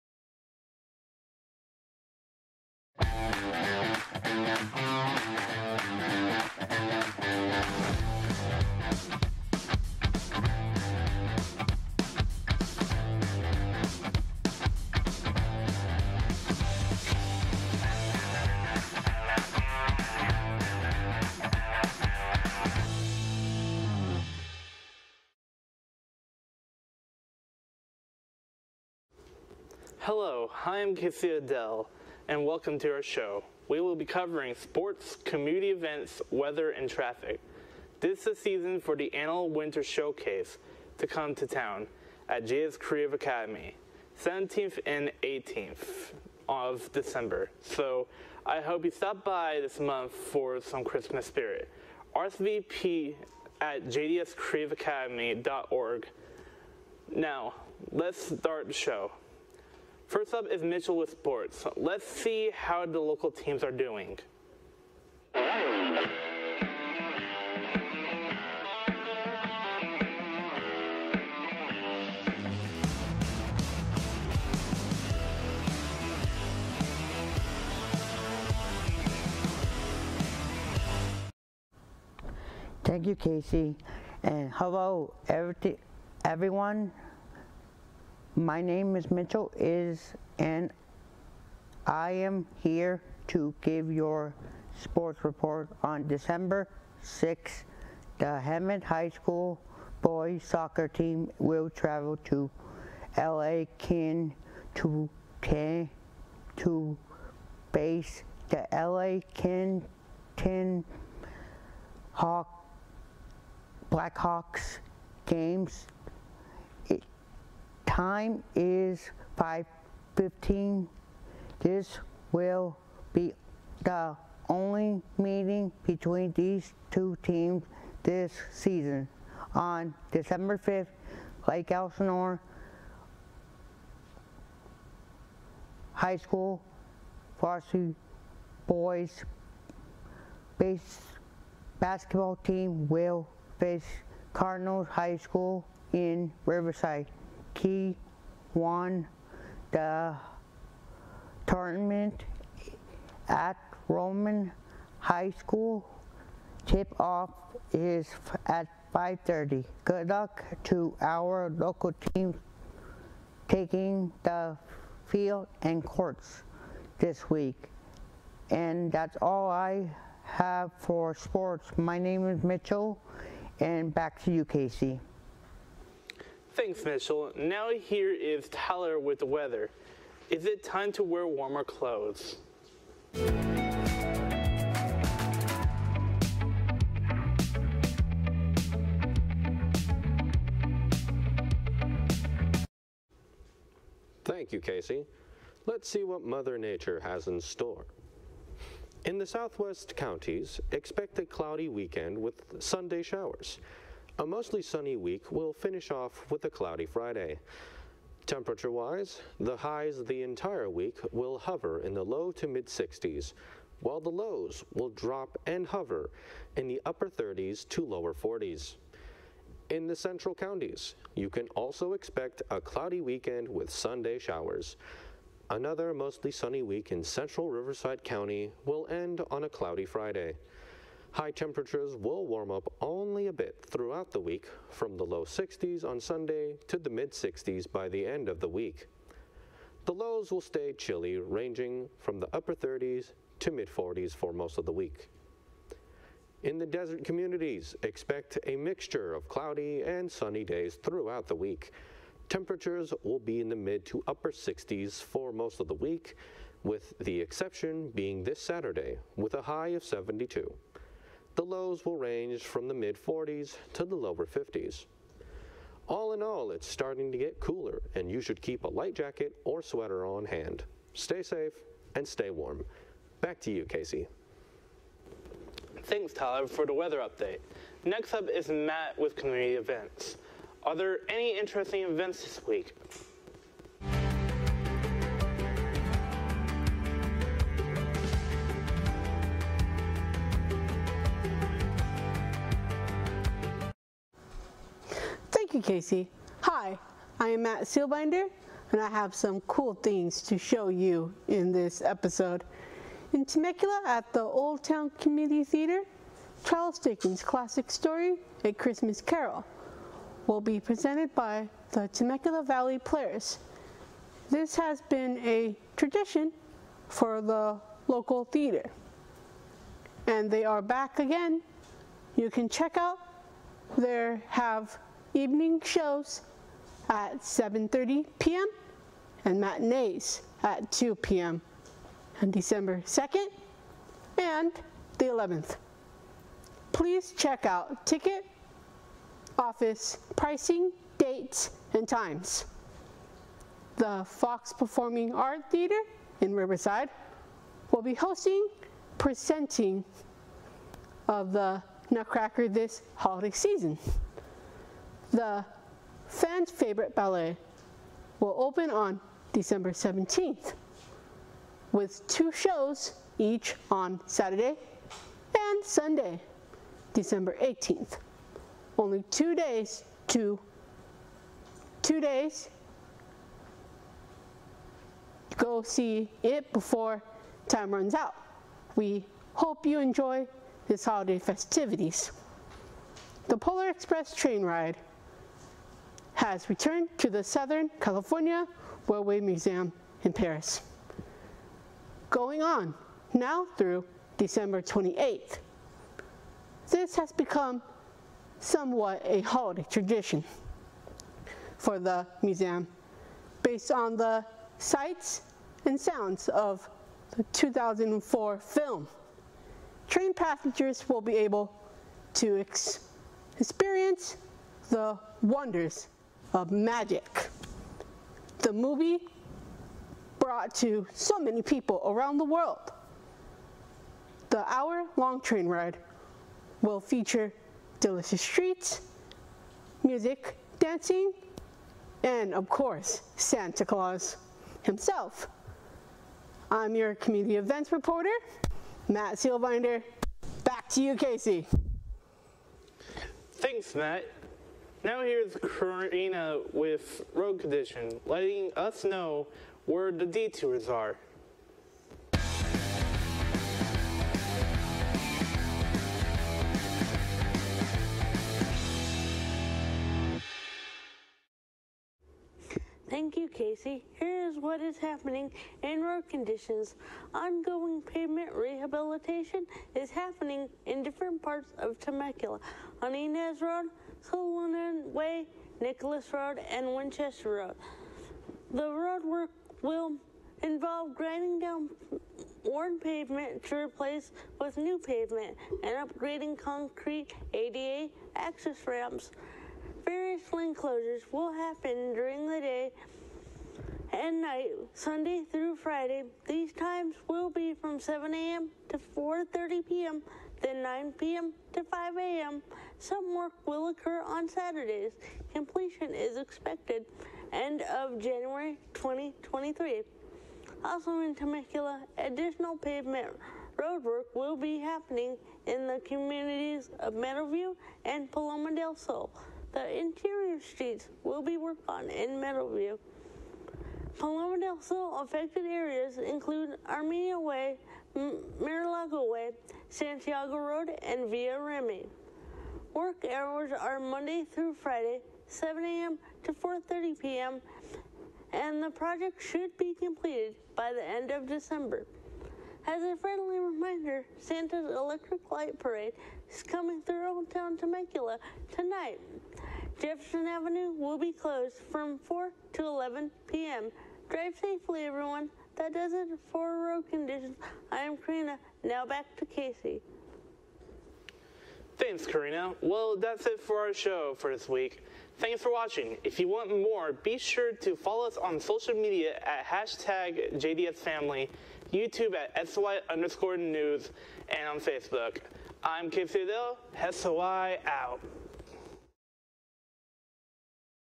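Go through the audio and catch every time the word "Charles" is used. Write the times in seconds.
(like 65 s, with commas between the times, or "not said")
306 s.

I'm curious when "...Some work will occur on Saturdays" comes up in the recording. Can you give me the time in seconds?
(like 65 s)
502 s.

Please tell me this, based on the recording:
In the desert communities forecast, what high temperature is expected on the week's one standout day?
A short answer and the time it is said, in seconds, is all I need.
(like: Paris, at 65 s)
72, at 259 s.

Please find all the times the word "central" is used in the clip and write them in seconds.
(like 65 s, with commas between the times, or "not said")
219 s, 227 s.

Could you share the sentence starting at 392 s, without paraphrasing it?
Going on now through December 28th.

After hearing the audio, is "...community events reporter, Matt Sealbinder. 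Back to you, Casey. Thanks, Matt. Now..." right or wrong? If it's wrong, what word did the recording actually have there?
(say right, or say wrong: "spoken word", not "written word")
right.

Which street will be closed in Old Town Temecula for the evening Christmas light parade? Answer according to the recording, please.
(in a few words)
Jefferson Avenue.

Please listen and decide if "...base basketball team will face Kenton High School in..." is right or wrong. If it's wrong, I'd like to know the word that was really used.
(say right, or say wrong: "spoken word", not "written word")
wrong: "Cardinals", not "Kenton".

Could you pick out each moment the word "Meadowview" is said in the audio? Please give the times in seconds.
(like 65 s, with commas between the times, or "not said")
516 s, 522 s.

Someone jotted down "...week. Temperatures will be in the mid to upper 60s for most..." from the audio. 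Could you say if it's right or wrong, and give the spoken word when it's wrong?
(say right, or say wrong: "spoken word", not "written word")
right.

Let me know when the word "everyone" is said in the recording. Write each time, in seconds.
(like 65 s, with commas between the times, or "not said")
86 s, 554 s.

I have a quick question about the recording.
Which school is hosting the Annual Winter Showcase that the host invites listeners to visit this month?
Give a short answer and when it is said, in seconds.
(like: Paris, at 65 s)
JDS Creative Academy, at 42 s.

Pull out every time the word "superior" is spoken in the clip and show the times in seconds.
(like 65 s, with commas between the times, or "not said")
not said.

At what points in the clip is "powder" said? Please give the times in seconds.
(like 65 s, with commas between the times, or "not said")
not said.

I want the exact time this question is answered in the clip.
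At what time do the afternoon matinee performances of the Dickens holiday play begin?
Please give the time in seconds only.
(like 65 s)
330 s.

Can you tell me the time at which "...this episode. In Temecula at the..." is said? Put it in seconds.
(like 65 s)
301 s.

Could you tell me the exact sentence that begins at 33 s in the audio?
We will be covering sports, community events, weather, and traffic.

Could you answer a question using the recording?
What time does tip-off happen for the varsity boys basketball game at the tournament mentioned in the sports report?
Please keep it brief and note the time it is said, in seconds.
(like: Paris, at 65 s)
5:30, at 158 s.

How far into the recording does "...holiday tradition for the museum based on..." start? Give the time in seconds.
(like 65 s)
399 s.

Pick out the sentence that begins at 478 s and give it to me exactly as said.
The road work will involve grinding down worn pavement to replace with new pavement and upgrading concrete ADA access ramps.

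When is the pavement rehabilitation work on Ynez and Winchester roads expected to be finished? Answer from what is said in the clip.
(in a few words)
end of January 2023.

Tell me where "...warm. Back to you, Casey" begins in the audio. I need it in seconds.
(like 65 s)
272 s.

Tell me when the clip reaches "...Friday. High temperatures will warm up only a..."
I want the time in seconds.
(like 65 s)
229 s.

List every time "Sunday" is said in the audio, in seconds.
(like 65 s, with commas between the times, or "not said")
202 s, 223 s, 235 s, 365 s, 494 s.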